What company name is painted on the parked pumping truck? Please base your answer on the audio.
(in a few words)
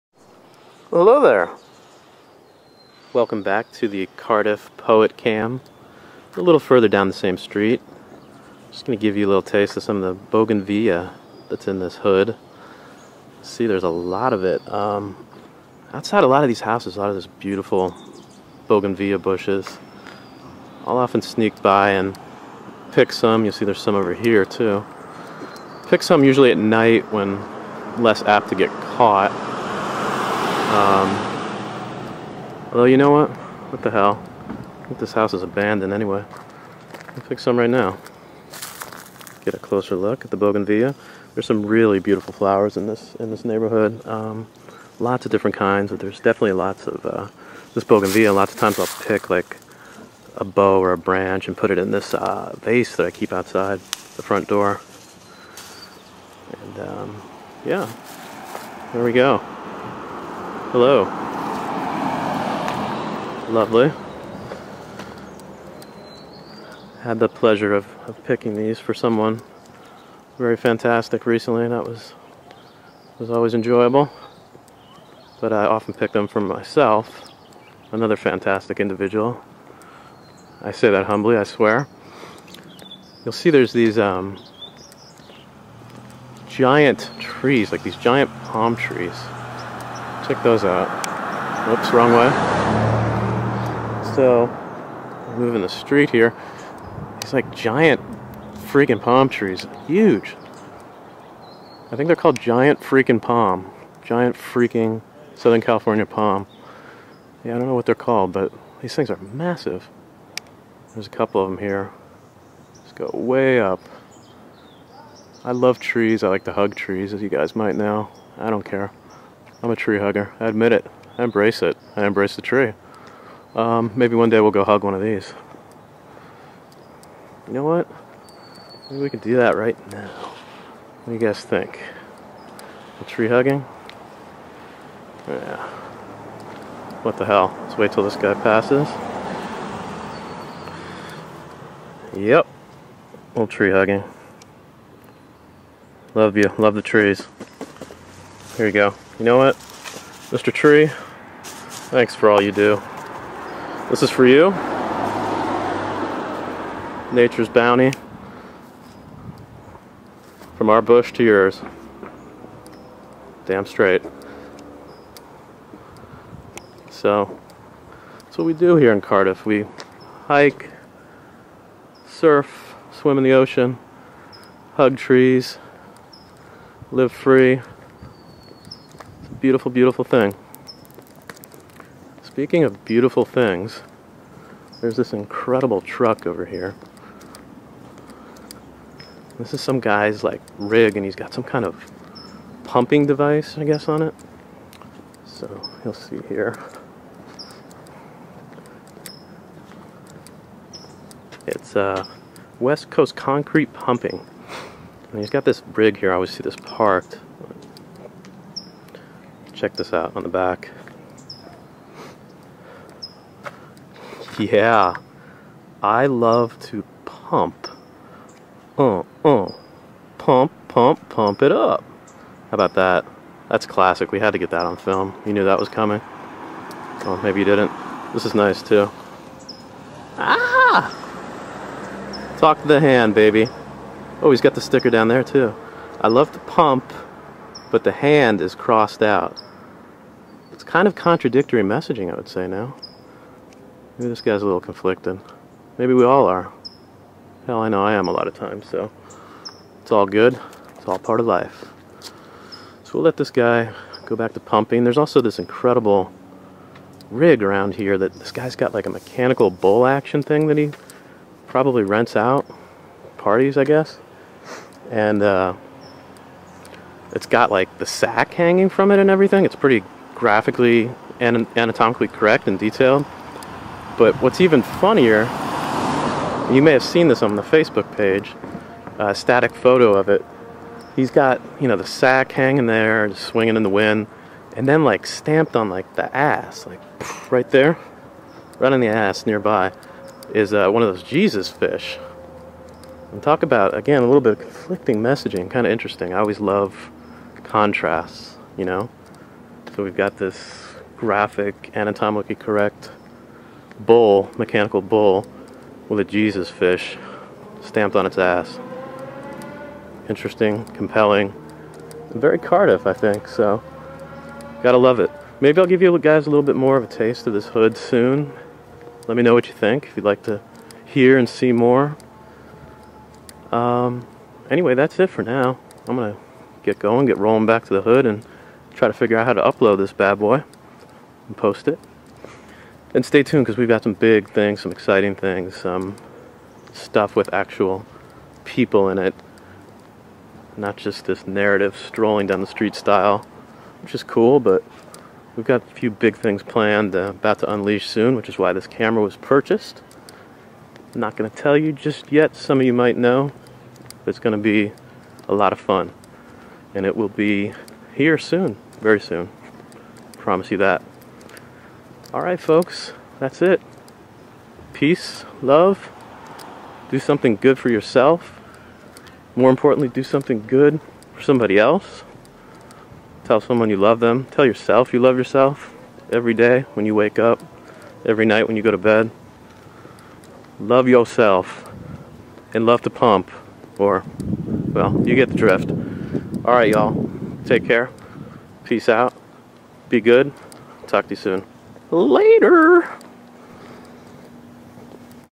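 West Coast Concrete Pumping.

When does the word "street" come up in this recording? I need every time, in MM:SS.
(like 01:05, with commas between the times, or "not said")
00:07, 01:35, 05:42.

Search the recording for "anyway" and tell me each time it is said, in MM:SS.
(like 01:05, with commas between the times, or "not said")
00:35, 05:24.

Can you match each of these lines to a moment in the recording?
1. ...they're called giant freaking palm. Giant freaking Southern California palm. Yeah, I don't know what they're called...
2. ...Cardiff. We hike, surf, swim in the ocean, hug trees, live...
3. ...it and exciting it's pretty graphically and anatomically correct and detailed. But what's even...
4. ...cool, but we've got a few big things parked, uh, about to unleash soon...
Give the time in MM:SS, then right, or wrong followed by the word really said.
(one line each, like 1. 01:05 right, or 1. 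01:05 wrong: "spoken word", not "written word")
1. 01:42 right
2. 02:48 right
3. 04:28 wrong: "everything", not "exciting"
4. 05:44 wrong: "planned", not "parked".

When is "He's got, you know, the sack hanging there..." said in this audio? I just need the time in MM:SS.
04:40.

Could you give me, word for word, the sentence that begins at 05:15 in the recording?
Maybe I'll give you guys a little bit more of a taste of this hood soon.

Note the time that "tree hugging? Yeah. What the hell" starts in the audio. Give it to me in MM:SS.
02:13.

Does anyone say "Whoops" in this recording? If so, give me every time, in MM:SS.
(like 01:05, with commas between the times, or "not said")
01:31.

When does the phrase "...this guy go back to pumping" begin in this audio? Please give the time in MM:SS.
04:13.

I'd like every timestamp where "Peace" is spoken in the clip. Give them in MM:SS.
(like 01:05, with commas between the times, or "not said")
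06:04, 06:28.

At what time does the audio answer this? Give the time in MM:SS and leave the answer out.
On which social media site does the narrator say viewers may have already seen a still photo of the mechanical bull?
04:37.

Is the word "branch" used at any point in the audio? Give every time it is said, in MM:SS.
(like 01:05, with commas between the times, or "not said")
00:50.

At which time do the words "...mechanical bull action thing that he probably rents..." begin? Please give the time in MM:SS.
04:18.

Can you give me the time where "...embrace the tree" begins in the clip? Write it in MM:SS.
02:02.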